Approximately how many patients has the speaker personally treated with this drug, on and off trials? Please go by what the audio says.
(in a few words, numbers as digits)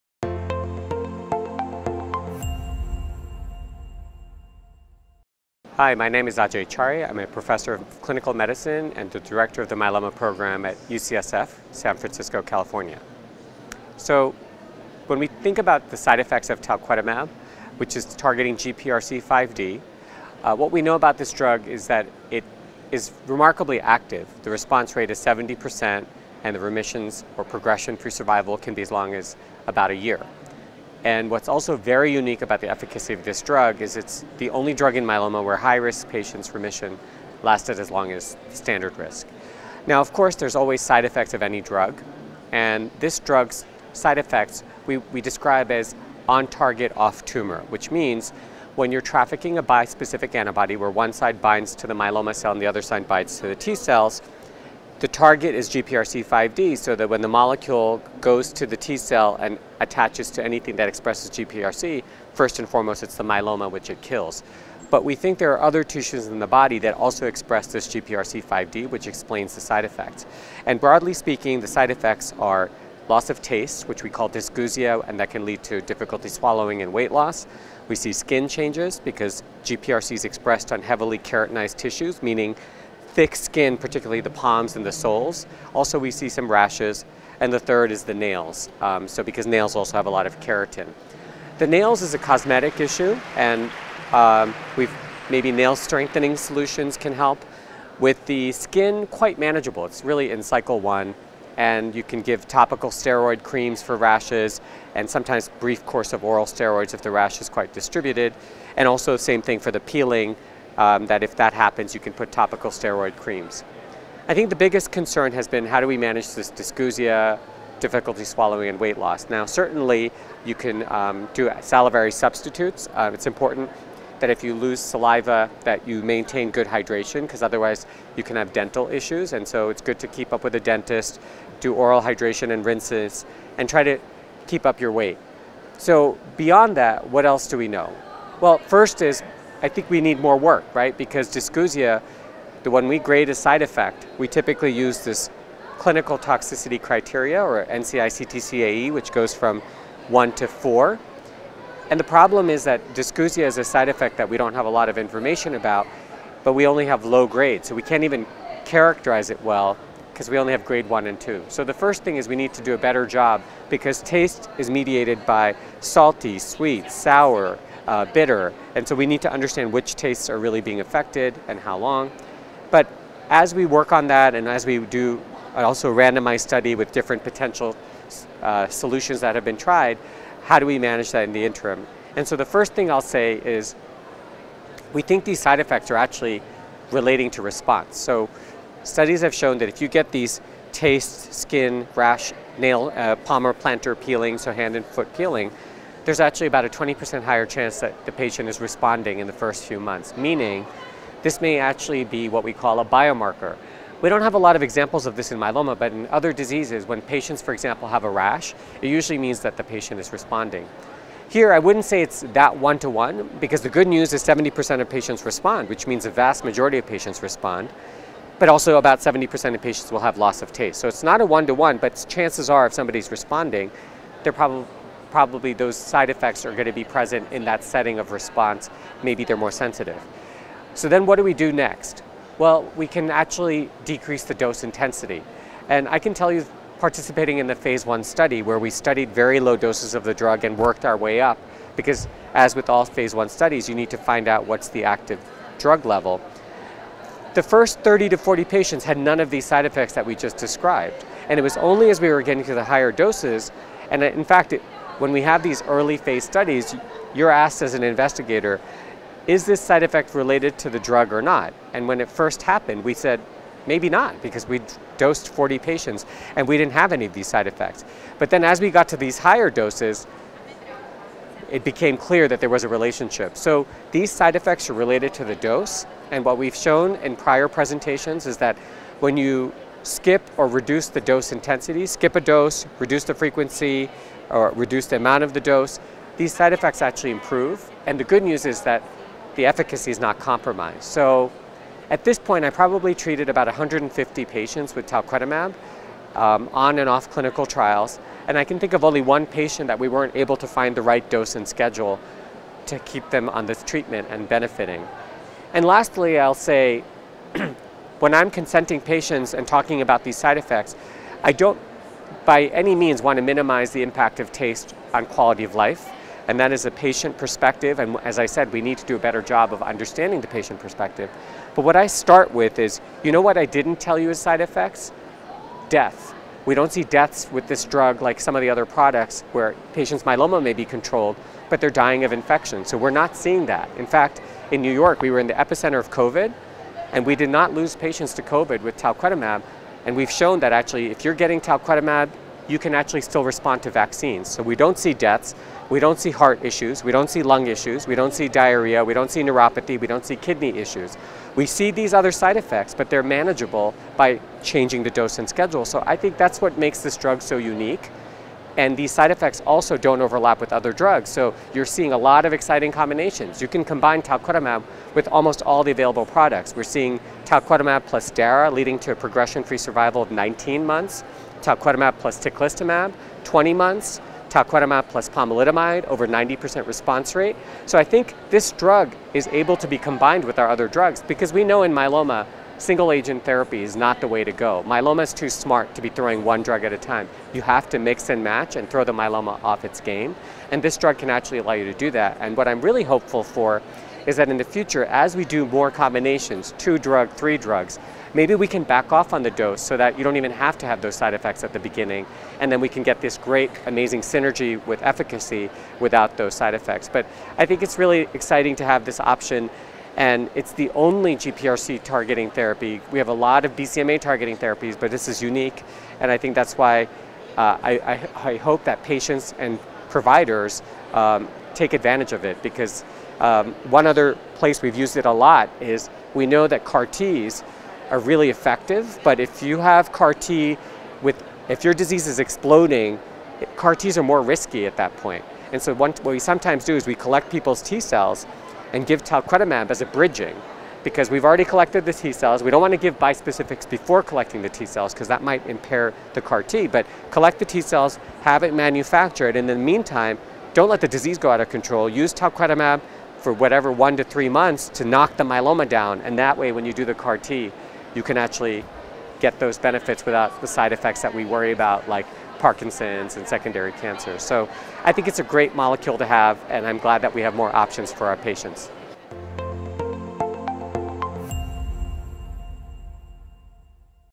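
150.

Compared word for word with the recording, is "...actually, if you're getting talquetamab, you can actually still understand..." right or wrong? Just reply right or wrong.
wrong.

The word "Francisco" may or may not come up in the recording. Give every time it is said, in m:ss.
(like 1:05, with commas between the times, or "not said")
0:11.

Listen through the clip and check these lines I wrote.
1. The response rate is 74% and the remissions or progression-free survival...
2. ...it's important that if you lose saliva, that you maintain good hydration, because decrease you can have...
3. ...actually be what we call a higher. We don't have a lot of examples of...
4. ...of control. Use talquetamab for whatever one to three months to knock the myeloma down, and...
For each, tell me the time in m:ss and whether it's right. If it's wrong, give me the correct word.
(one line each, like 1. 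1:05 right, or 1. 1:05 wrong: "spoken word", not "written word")
1. 0:24 wrong: "70", not "74"
2. 2:03 wrong: "otherwise", not "decrease"
3. 3:21 wrong: "biomarker", not "higher"
4. 7:31 right.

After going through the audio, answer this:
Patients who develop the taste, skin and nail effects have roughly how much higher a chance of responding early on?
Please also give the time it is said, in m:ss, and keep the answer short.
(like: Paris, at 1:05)
20%, at 3:16.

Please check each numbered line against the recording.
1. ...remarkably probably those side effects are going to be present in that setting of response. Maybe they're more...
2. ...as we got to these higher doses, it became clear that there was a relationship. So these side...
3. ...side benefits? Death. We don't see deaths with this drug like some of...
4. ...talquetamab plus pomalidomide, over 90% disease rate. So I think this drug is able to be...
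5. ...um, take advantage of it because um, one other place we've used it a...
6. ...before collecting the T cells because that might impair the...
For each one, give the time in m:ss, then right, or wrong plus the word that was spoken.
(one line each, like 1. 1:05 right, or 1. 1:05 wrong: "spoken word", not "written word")
1. 3:44 wrong: "probably", not "remarkably"
2. 4:28 right
3. 5:24 wrong: "effects", not "benefits"
4. 6:14 wrong: "response", not "disease"
5. 7:00 right
6. 7:23 right.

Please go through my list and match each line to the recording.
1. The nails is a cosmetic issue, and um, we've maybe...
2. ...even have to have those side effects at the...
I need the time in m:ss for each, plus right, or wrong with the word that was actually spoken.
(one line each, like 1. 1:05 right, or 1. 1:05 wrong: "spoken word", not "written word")
1. 1:31 right
2. 6:40 right.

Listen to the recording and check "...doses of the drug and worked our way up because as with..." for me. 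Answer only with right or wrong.
right.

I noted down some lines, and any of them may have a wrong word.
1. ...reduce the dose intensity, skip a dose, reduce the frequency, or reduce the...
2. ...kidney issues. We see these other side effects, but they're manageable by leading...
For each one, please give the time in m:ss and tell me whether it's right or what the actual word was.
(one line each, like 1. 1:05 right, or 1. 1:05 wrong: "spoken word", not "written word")
1. 4:40 right
2. 5:50 wrong: "changing", not "leading".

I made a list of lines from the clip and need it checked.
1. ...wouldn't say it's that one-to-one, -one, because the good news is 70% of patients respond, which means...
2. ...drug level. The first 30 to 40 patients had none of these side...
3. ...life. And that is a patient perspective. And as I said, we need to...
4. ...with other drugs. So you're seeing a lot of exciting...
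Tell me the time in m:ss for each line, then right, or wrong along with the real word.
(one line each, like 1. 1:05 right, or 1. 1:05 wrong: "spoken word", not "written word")
1. 3:31 right
2. 4:05 right
3. 5:15 right
4. 6:00 right.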